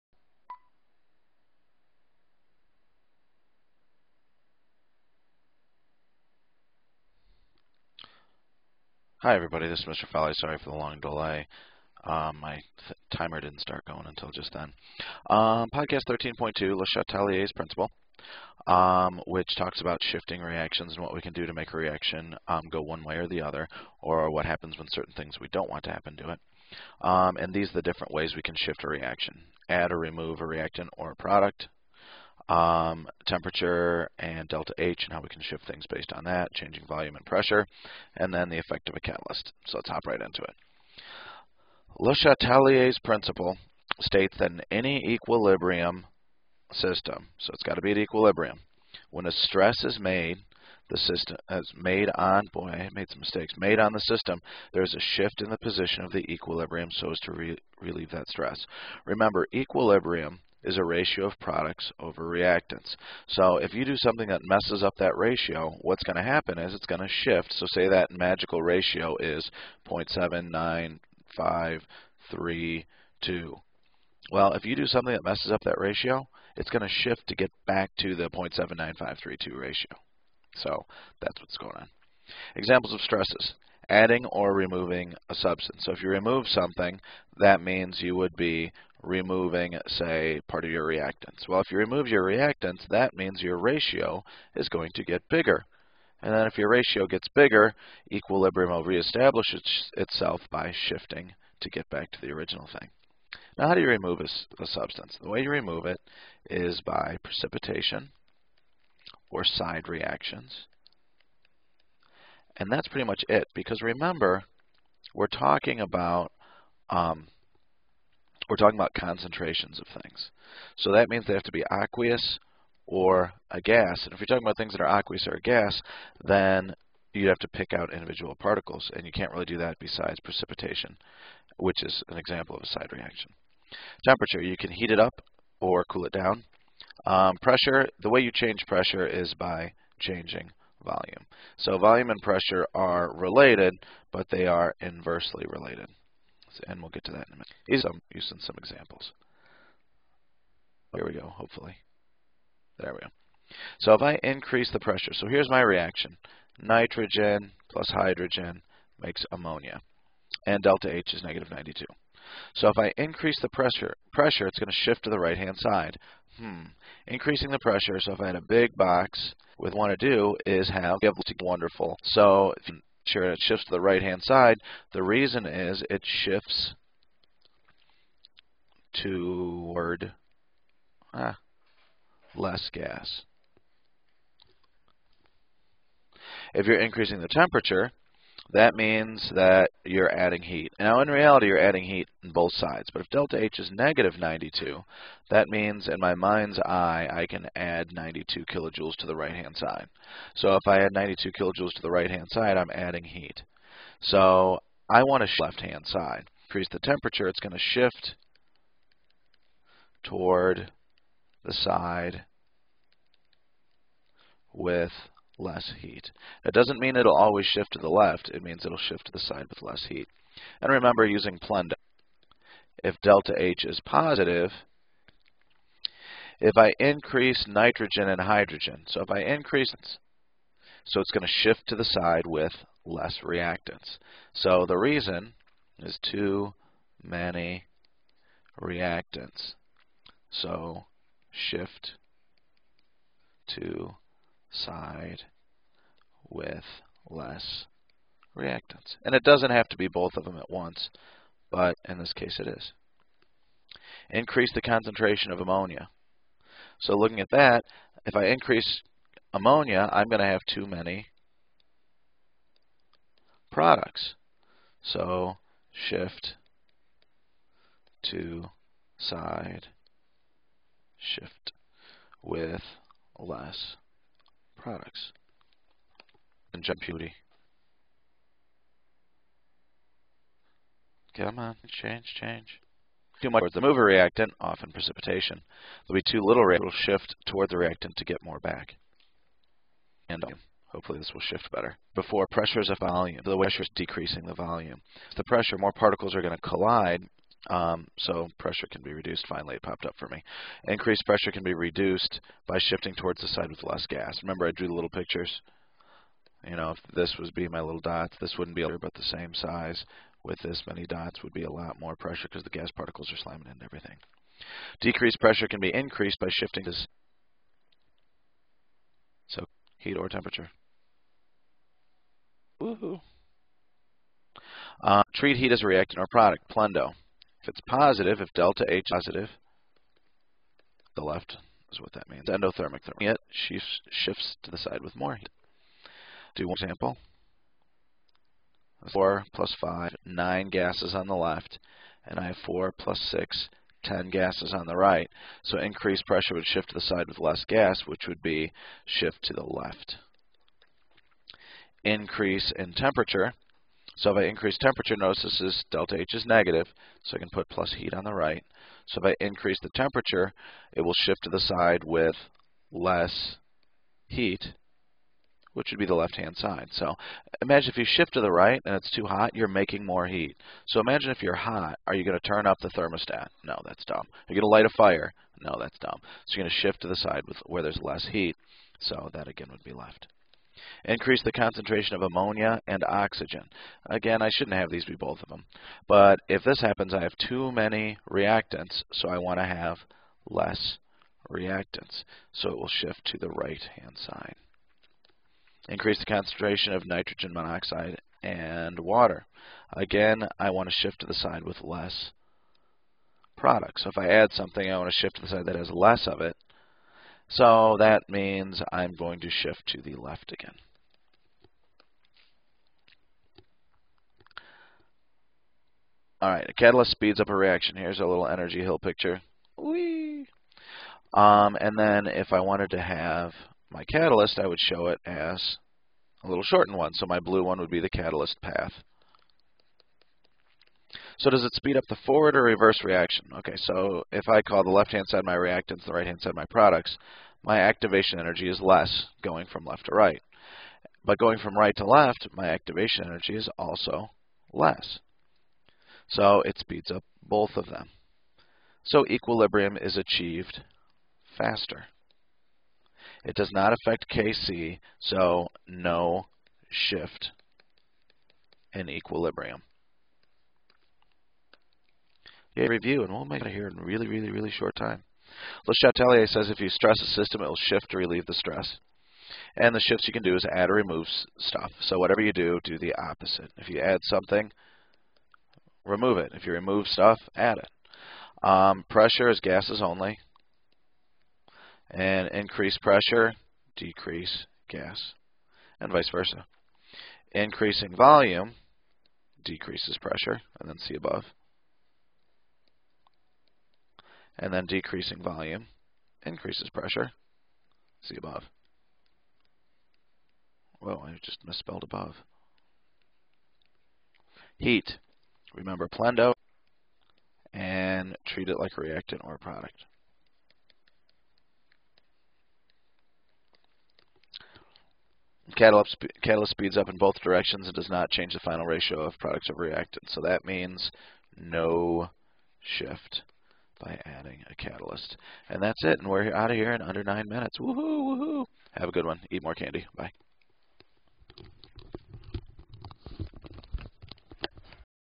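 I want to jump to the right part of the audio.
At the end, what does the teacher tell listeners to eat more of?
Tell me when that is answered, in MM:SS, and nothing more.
08:49.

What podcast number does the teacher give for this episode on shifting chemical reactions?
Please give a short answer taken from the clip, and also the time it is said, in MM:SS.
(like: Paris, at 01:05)
13.2, at 00:16.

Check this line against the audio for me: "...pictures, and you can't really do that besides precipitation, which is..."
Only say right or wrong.
wrong.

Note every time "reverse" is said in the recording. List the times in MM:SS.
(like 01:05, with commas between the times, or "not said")
07:12.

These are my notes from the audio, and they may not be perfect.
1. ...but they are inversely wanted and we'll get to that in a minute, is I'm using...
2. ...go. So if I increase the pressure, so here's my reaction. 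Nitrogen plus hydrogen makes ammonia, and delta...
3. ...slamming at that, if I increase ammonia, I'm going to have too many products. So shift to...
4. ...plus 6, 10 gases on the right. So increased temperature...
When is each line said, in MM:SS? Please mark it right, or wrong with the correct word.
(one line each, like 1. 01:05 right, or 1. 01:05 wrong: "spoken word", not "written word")
1. 02:24 wrong: "related", not "wanted"
2. 02:32 right
3. 04:16 wrong: "looking", not "slamming"
4. 05:42 wrong: "pressure", not "temperature".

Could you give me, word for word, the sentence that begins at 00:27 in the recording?
Um, and these are the different ways we can shift a reaction.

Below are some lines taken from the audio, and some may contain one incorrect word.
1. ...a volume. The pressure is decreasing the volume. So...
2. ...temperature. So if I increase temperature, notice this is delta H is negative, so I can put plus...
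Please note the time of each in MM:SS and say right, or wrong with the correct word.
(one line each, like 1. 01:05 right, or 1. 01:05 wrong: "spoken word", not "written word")
1. 04:52 right
2. 05:52 right.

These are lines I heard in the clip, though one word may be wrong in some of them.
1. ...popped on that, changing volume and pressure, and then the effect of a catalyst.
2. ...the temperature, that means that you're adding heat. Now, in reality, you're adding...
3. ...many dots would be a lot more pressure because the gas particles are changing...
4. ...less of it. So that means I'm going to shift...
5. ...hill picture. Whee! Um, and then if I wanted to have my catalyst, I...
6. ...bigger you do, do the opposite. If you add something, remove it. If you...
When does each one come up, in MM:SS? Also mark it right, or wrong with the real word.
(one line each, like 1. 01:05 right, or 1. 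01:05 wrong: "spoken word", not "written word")
1. 00:35 wrong: "based", not "popped"
2. 03:07 right
3. 05:10 wrong: "slamming", not "changing"
4. 06:45 right
5. 06:58 right
6. 07:51 wrong: "whatever", not "bigger".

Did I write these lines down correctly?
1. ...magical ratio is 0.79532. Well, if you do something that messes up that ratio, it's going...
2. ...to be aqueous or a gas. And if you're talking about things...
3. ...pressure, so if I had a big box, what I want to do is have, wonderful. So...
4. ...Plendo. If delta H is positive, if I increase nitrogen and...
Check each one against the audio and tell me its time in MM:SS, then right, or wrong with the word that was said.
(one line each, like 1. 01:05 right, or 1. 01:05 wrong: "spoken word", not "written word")
1. 01:08 right
2. 02:01 right
3. 02:47 right
4. 03:41 right.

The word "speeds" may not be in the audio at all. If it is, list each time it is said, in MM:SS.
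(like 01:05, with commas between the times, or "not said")
06:56, 07:11, 07:26, 08:36.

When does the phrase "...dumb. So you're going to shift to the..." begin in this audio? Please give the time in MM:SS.
06:15.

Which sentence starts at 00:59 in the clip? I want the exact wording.
Remember, equilibrium is a ratio of products over reactants.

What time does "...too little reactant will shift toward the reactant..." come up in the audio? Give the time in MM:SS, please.
04:46.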